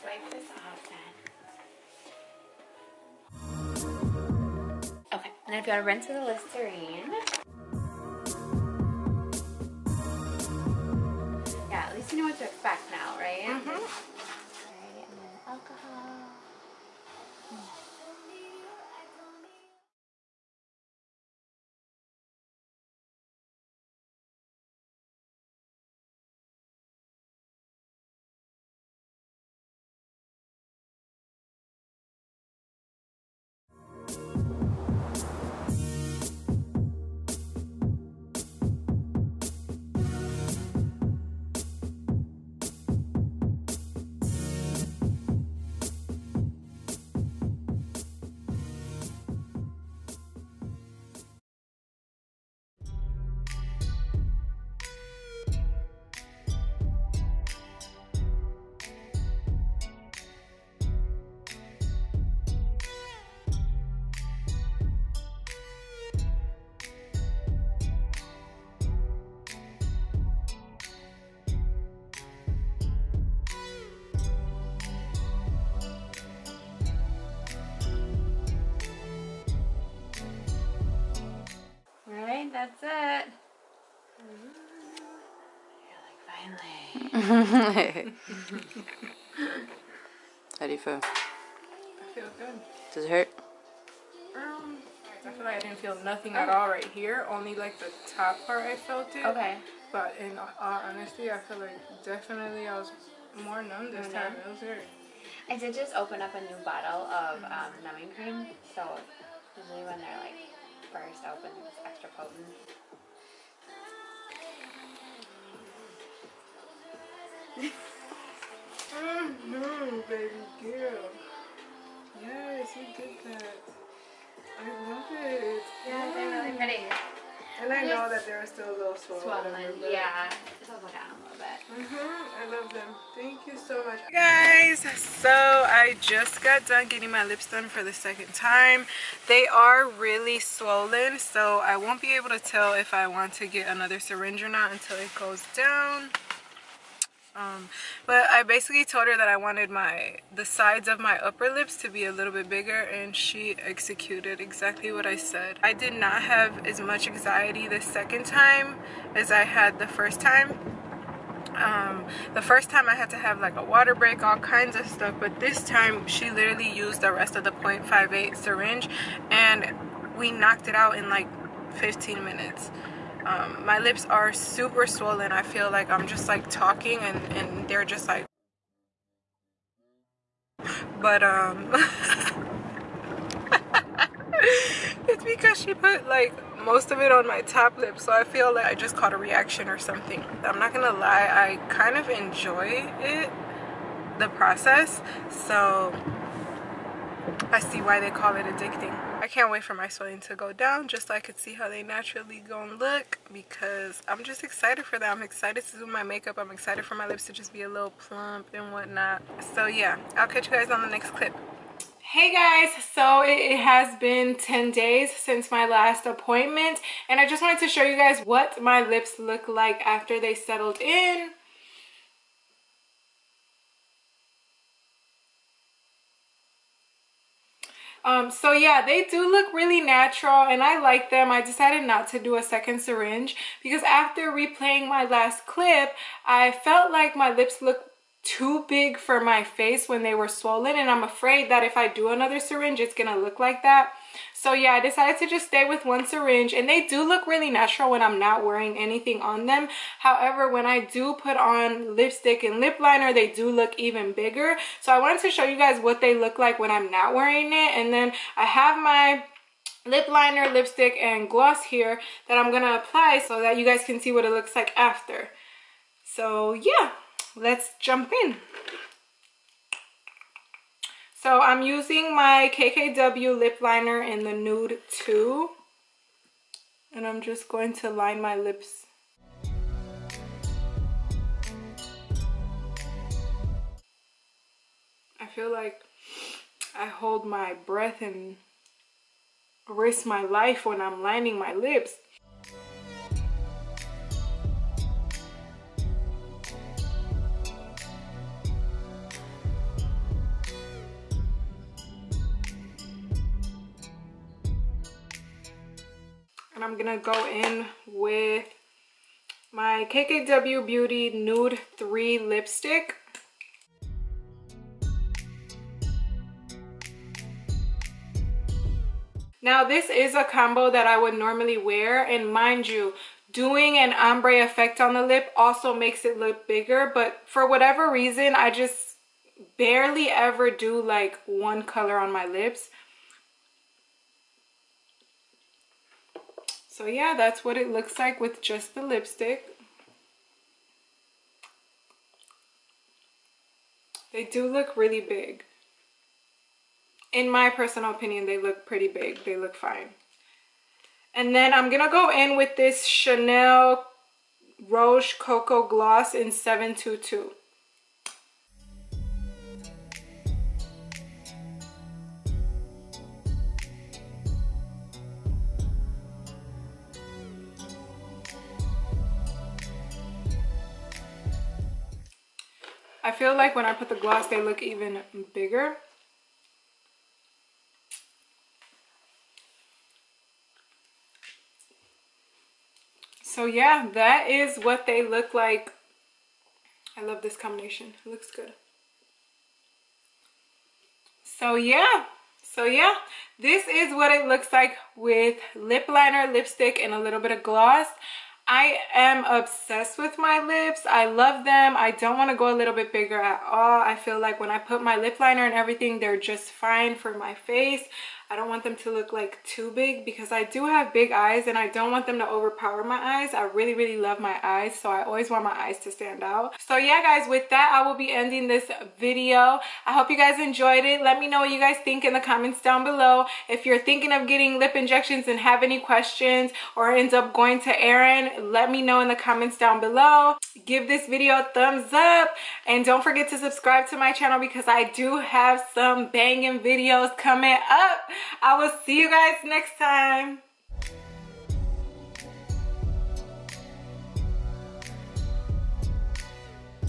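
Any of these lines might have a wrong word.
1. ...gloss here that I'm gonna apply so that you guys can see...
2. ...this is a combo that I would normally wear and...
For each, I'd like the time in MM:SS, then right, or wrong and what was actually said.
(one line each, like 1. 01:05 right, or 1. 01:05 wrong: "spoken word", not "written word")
1. 04:21 right
2. 05:19 right.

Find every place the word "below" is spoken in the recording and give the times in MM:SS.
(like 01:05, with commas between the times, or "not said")
07:02, 07:09.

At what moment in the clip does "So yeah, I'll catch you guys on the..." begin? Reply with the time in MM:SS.
03:29.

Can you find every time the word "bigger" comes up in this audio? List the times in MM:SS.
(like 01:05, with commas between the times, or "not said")
02:32, 04:14, 05:26, 06:15, 06:42.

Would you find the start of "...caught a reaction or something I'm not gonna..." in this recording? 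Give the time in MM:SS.
03:08.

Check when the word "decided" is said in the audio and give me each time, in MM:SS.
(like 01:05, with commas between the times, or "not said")
03:51, 04:04.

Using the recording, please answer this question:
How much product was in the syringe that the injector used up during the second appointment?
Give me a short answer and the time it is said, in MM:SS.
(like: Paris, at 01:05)
0.58, at 02:47.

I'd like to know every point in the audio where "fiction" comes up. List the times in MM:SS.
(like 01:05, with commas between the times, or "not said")
not said.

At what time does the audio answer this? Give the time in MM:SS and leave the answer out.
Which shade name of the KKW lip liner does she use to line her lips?
04:34.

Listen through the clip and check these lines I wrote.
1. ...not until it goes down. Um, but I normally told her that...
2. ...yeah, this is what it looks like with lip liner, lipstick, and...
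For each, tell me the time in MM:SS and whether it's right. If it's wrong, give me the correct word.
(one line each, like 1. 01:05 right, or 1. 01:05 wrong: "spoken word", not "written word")
1. 02:24 wrong: "basically", not "normally"
2. 06:32 right.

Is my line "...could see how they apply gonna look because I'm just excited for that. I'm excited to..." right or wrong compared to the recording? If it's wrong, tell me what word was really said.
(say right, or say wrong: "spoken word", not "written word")
wrong: "naturally", not "apply".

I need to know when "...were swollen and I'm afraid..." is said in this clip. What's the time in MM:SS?
04:00.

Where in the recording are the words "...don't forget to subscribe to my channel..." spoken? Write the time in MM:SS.
07:12.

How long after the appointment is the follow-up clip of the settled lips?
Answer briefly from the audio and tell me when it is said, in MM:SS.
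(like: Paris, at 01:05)
10 days, at 03:34.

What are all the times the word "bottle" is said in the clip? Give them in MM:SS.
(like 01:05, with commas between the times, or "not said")
01:46.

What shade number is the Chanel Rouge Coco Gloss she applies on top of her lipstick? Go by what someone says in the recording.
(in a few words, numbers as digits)
722.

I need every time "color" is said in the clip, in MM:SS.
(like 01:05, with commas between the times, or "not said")
05:31.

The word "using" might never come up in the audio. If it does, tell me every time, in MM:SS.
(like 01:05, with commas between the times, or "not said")
04:31.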